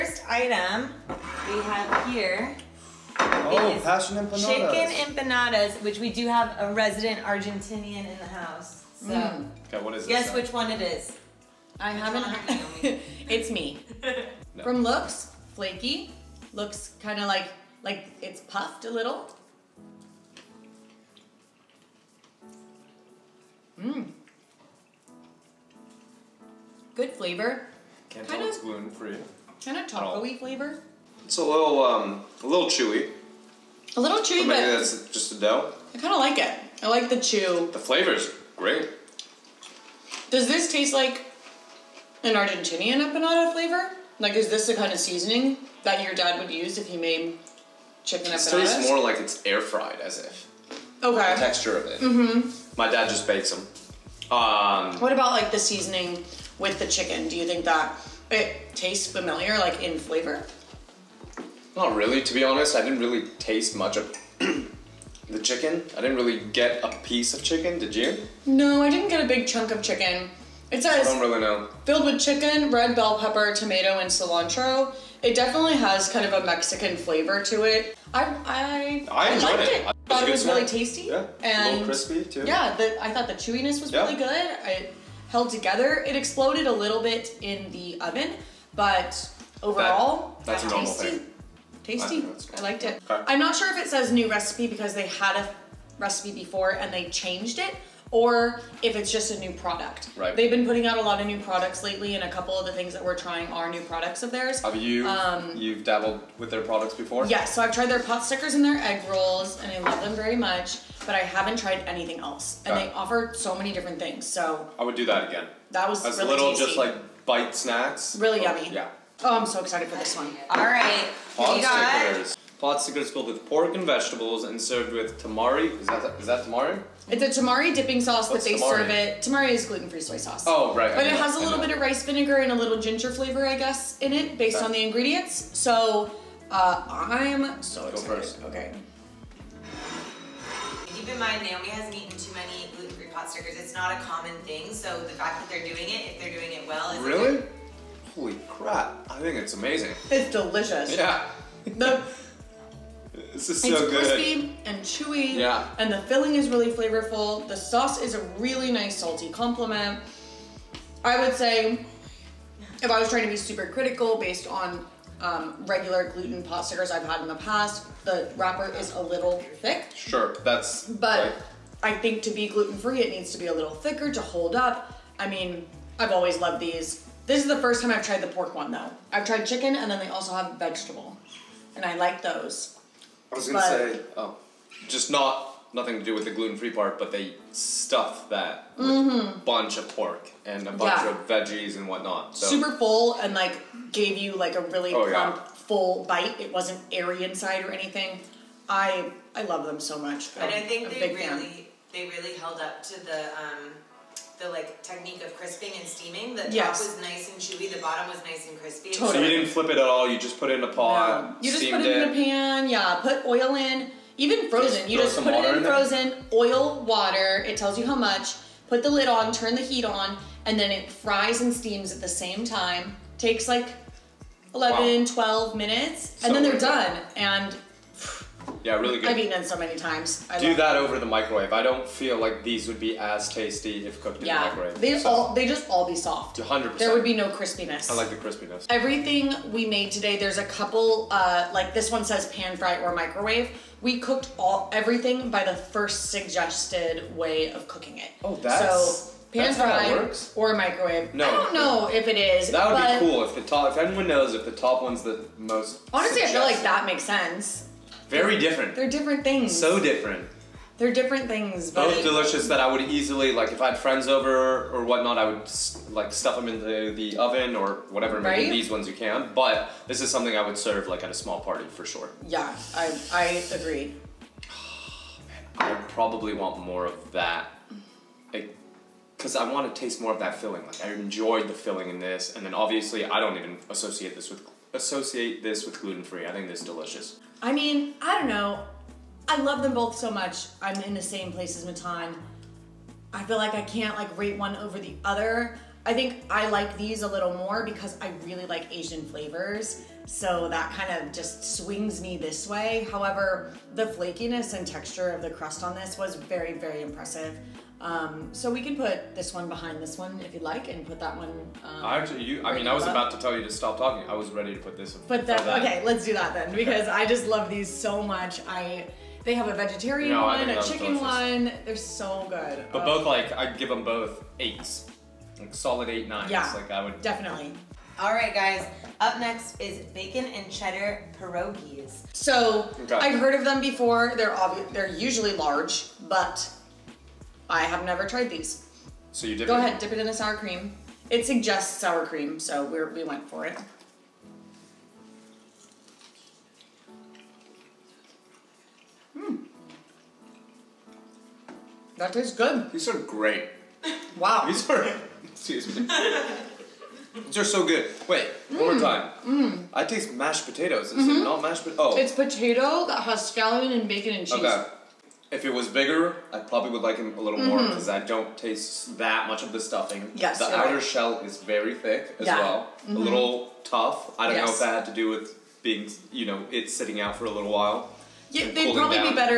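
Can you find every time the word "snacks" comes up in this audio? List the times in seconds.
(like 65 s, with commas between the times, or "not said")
117 s.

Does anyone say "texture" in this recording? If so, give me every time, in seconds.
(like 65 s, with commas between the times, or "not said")
51 s, 304 s.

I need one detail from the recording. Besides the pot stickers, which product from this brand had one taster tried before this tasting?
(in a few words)
egg rolls.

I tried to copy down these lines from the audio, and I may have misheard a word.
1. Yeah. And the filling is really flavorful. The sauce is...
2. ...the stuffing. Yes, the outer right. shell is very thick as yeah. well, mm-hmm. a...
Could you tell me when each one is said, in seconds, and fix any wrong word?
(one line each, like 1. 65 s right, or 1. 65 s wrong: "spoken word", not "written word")
1. 155 s right
2. 369 s right.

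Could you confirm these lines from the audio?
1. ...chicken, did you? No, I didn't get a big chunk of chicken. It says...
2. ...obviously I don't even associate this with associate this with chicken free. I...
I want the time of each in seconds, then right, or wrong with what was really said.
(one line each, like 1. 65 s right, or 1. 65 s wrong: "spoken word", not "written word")
1. 67 s right
2. 282 s wrong: "gluten", not "chicken".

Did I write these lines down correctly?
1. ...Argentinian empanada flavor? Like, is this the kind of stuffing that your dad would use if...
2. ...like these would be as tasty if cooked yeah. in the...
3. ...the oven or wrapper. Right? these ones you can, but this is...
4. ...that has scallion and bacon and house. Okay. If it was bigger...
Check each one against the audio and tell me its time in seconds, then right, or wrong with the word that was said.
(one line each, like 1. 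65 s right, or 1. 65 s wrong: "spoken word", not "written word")
1. 42 s wrong: "seasoning", not "stuffing"
2. 232 s right
3. 266 s wrong: "whatever", not "wrapper"
4. 362 s wrong: "cheese", not "house".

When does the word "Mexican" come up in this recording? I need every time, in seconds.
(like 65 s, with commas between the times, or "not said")
76 s.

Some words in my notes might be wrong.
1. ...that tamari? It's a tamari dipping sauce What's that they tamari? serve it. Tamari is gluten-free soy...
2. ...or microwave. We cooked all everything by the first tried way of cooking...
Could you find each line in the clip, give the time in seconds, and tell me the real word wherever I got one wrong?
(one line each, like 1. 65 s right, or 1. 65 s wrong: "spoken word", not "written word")
1. 126 s right
2. 242 s wrong: "suggested", not "tried".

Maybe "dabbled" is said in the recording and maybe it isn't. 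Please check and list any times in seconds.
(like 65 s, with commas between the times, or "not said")
105 s.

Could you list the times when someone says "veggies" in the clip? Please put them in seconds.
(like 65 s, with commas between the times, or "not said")
191 s.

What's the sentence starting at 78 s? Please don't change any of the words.
I I, I enjoyed liked it.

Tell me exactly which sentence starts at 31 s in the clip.
It's a little um, a little chewy.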